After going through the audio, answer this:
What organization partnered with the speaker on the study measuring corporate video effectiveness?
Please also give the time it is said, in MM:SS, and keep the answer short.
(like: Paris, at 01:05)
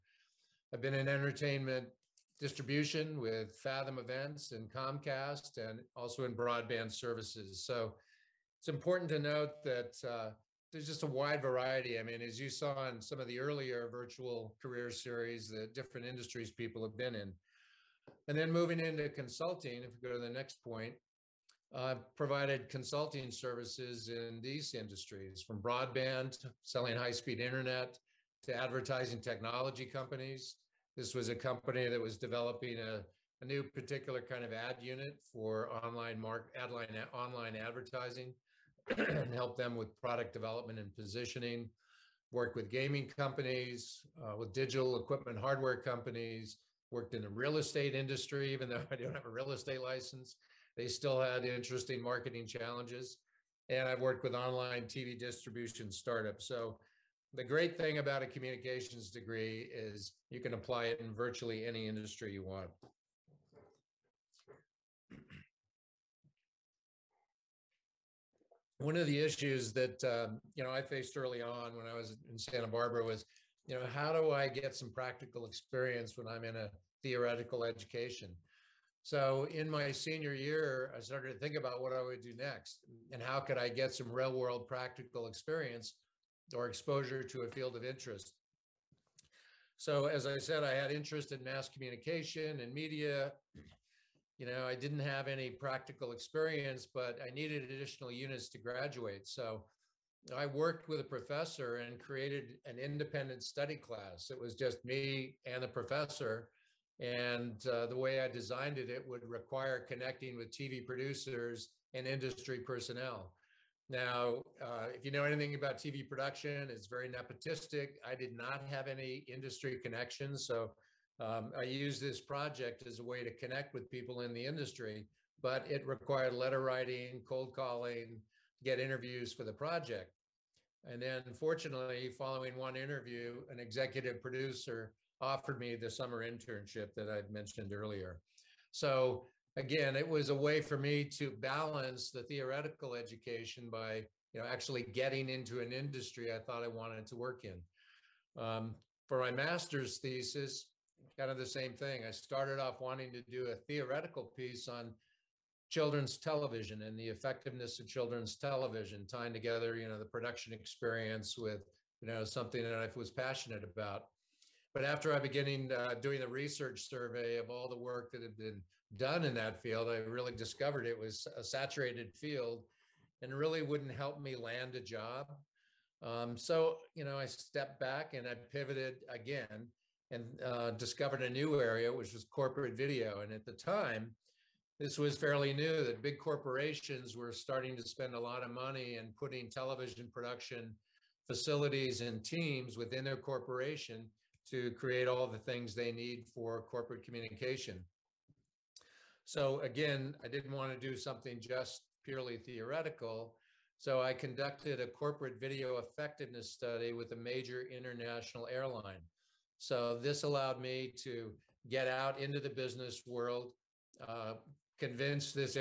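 A major international airline, at 03:27.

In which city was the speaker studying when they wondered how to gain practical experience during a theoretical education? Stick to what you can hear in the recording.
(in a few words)
Santa Barbara.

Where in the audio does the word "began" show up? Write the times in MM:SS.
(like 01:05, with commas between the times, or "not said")
02:45.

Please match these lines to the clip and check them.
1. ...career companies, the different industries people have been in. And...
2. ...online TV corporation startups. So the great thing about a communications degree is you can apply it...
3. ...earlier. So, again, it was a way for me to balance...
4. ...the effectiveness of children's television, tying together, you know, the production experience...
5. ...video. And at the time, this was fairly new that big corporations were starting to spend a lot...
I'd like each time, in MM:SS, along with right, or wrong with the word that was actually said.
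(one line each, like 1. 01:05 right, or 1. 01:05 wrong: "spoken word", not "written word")
1. 00:14 wrong: "series", not "companies"
2. 00:54 wrong: "distribution", not "corporation"
3. 02:17 right
4. 02:36 right
5. 03:02 right.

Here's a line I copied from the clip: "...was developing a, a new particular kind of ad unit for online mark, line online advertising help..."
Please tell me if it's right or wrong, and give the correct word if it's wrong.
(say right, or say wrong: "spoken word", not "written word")
right.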